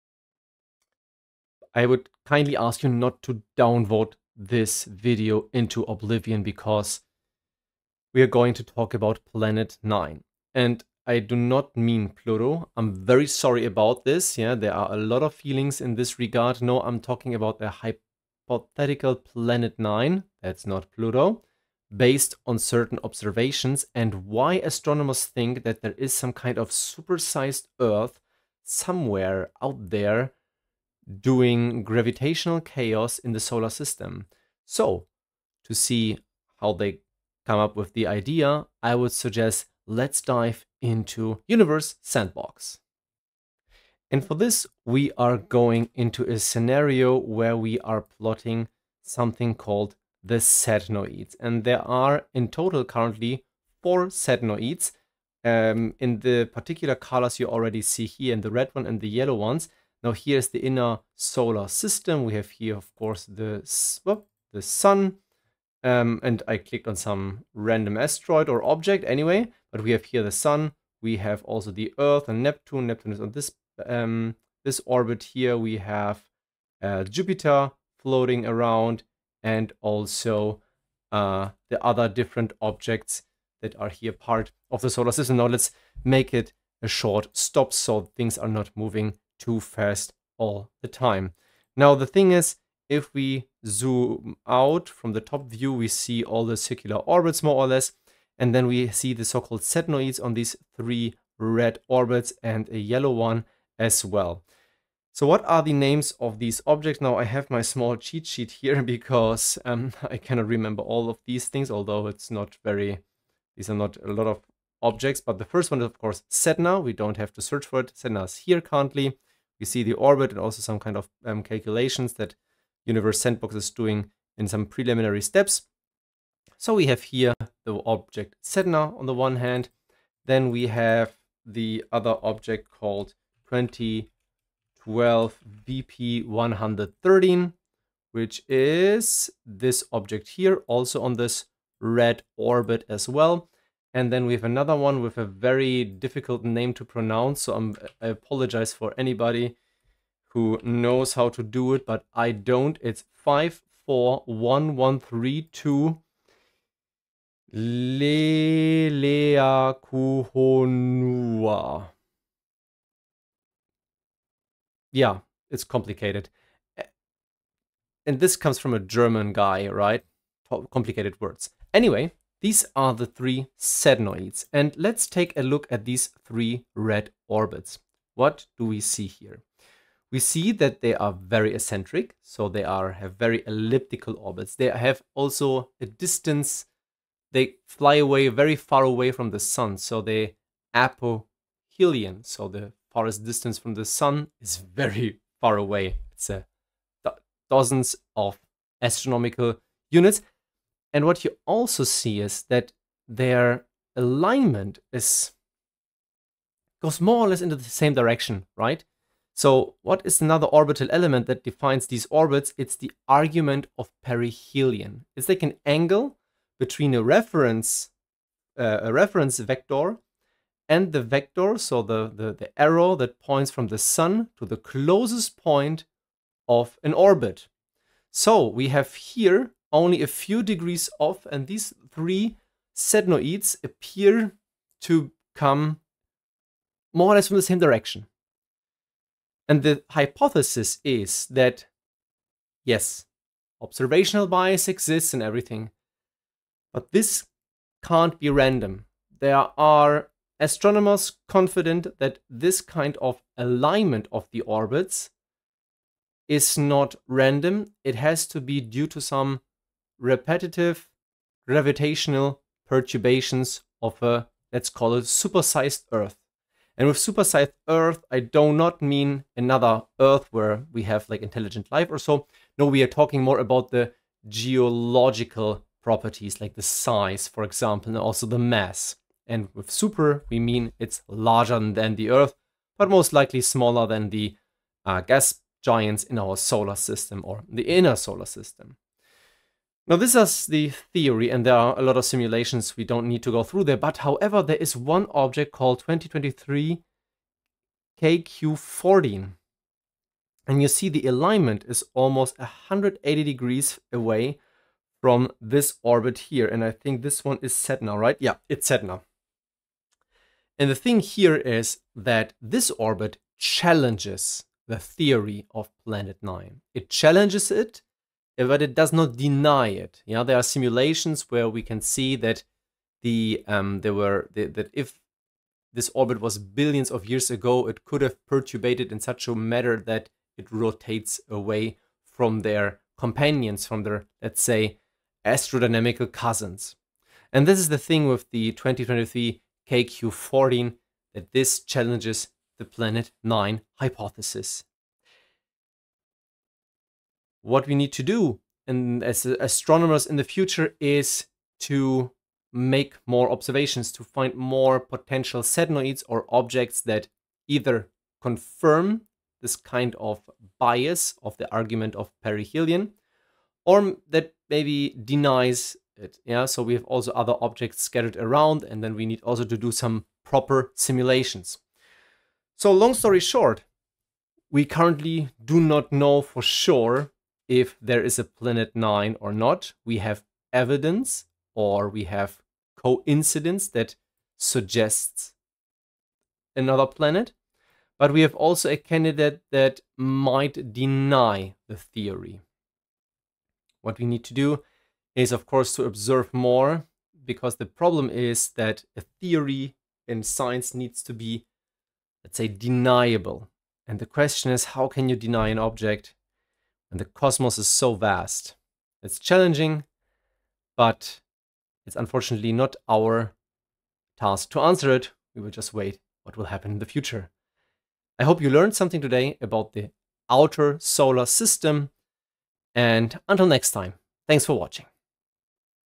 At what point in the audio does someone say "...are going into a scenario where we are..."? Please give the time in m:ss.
0:45.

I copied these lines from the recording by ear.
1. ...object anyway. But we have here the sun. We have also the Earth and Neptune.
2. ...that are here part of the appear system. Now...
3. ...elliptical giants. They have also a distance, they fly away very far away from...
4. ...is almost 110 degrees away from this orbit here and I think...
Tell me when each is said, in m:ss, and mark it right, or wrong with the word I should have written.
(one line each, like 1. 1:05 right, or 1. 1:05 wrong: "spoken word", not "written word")
1. 1:08 right
2. 1:23 wrong: "solar", not "appear"
3. 3:03 wrong: "orbits", not "giants"
4. 5:01 wrong: "180", not "110".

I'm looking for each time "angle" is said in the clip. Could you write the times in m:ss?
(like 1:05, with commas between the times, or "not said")
3:35.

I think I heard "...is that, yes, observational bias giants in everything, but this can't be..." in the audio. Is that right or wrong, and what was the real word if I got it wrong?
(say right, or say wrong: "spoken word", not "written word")
wrong: "exists", not "giants".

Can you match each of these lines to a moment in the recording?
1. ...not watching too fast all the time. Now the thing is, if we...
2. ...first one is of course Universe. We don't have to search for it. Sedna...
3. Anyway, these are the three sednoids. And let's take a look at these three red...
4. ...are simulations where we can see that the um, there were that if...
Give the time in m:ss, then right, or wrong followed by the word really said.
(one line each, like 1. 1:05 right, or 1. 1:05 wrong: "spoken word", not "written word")
1. 1:28 wrong: "moving", not "watching"
2. 1:55 wrong: "Sedna", not "Universe"
3. 2:51 right
4. 5:20 right.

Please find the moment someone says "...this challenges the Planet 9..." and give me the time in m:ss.
5:41.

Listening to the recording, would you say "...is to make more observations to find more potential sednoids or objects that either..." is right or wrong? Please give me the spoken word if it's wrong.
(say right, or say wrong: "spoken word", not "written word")
right.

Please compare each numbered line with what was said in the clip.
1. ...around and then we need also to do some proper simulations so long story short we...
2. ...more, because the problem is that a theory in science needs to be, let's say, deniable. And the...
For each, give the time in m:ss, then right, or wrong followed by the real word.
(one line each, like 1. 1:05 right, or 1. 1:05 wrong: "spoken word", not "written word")
1. 6:08 right
2. 6:36 right.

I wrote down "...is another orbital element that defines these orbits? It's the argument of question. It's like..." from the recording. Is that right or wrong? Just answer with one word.
wrong.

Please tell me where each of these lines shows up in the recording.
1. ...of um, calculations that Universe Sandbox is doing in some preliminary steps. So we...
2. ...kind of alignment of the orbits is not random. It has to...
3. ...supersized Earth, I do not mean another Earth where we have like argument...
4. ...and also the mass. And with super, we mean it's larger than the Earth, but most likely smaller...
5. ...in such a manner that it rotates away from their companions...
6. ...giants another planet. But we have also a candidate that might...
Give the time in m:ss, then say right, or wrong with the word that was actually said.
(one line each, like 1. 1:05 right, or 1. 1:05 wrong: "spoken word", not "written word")
1. 2:00 right
2. 4:12 right
3. 4:26 wrong: "intelligent", not "argument"
4. 4:37 right
5. 5:28 right
6. 6:24 wrong: "suggests", not "giants".